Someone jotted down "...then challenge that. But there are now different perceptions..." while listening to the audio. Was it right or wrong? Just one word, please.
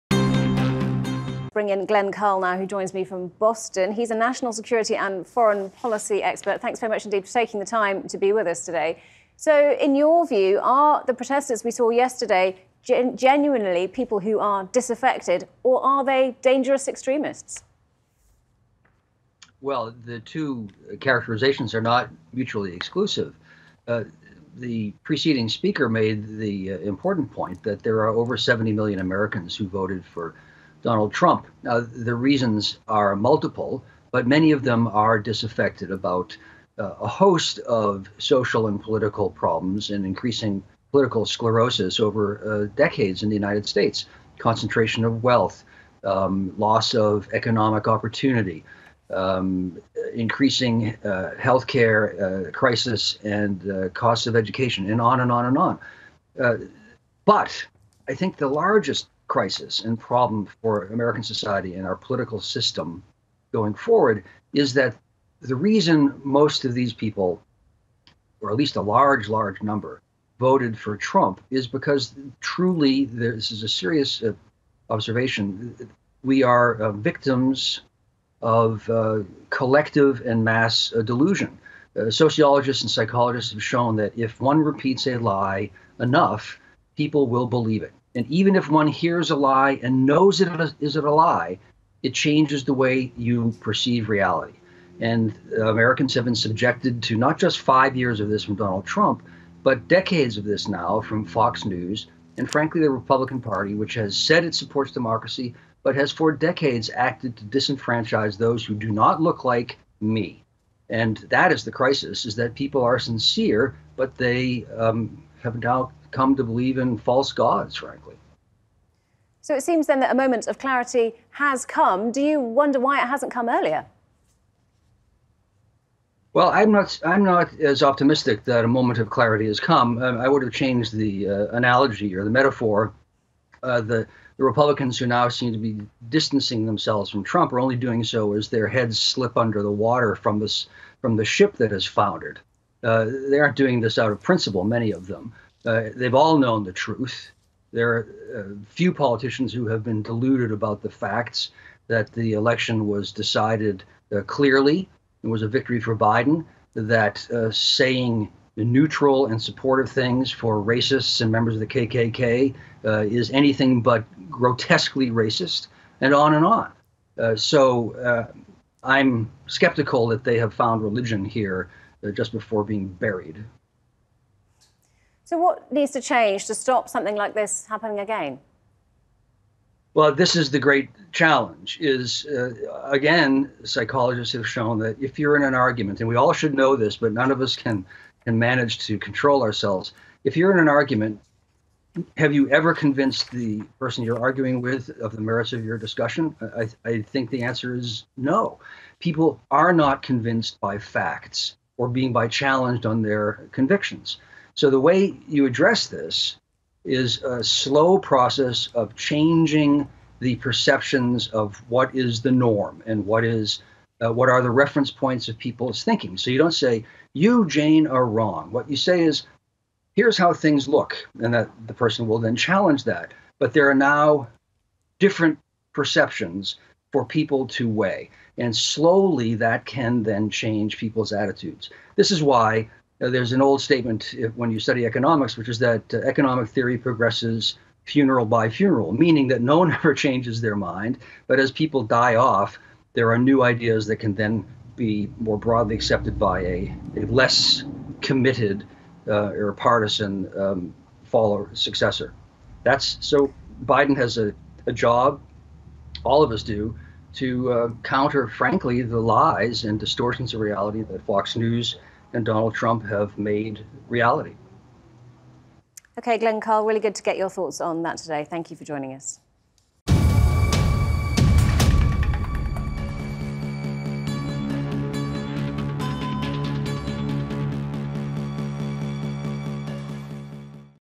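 right.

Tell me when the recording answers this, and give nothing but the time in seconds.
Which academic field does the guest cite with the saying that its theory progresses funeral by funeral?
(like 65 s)
234 s.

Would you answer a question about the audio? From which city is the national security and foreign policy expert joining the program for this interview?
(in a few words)
Boston.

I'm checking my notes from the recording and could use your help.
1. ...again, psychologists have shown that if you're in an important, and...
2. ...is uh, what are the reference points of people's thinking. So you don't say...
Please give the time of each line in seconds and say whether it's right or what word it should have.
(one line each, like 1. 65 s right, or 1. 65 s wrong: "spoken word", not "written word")
1. 182 s wrong: "argument", not "important"
2. 213 s right.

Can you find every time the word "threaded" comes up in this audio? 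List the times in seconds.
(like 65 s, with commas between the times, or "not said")
not said.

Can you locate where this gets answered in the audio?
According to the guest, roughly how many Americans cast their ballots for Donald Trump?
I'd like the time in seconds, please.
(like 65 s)
28 s.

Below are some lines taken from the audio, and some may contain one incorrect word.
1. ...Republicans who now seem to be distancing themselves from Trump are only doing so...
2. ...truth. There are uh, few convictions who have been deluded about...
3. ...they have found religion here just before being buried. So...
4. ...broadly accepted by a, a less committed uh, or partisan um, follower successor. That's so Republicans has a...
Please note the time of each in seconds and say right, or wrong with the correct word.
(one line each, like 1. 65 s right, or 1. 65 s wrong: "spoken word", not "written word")
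1. 134 s right
2. 146 s wrong: "politicians", not "convictions"
3. 170 s right
4. 245 s wrong: "Biden", not "Republicans".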